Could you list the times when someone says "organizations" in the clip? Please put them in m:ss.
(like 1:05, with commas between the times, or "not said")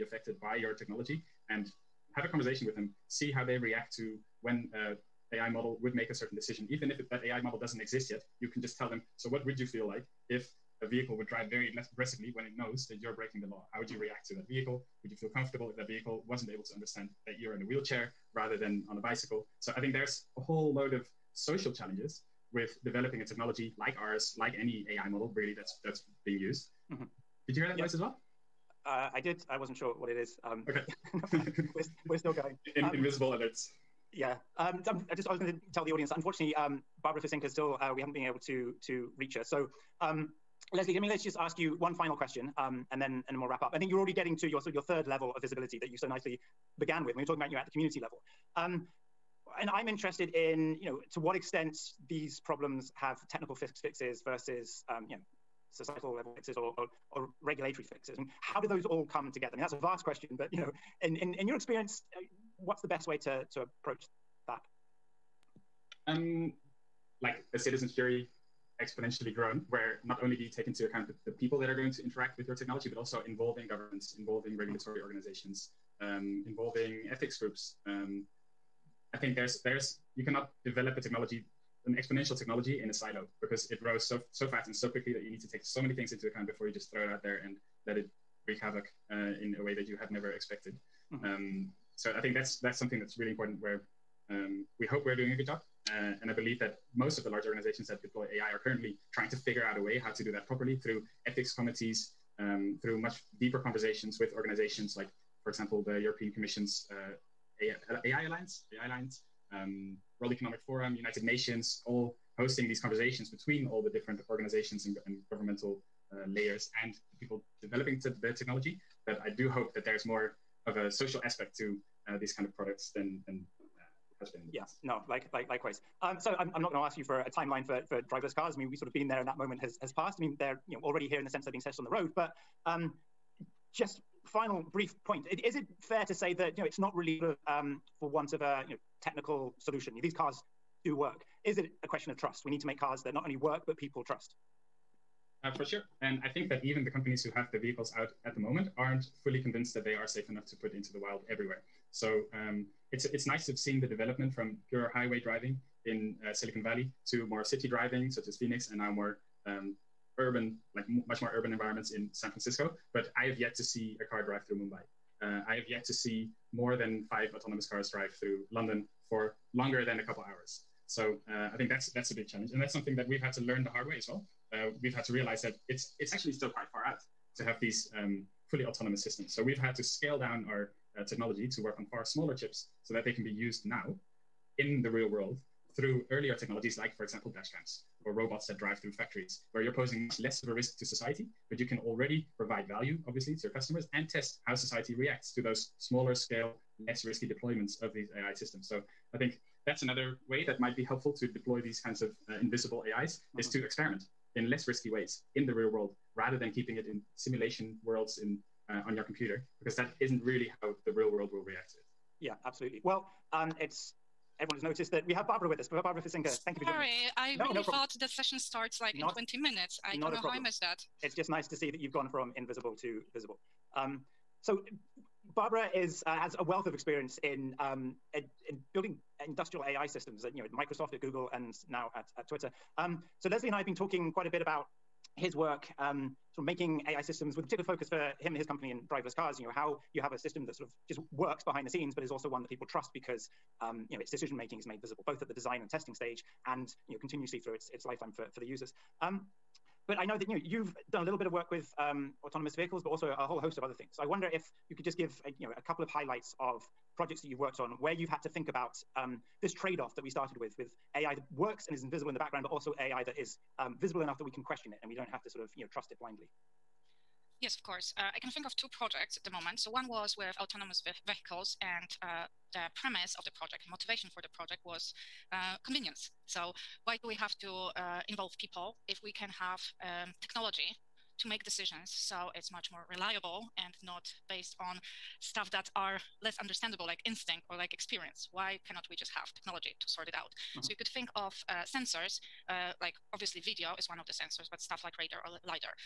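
1:15, 1:37, 1:44, 1:54.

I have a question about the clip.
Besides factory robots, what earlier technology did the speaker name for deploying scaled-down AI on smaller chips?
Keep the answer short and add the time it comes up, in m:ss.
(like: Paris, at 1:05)
dash cams, at 3:07.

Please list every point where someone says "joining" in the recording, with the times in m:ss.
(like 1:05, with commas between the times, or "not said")
3:36.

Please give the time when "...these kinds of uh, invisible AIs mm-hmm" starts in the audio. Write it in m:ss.
3:21.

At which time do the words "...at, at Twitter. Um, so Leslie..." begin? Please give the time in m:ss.
3:51.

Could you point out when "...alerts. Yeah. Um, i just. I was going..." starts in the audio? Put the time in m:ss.
0:33.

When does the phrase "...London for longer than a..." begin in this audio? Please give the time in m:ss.
2:48.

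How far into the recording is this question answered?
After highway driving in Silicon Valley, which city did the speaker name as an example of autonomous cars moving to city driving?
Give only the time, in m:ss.
2:38.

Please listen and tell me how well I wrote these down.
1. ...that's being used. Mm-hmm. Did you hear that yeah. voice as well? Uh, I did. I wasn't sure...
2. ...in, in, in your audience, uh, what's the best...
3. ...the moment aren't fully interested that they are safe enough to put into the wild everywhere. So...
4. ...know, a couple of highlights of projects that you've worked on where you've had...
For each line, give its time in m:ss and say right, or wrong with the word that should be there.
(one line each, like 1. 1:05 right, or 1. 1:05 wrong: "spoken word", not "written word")
1. 0:25 right
2. 1:01 wrong: "experience", not "audience"
3. 2:28 wrong: "convinced", not "interested"
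4. 4:15 right.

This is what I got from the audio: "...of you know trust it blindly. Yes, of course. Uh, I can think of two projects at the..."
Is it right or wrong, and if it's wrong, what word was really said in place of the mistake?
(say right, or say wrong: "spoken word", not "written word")
right.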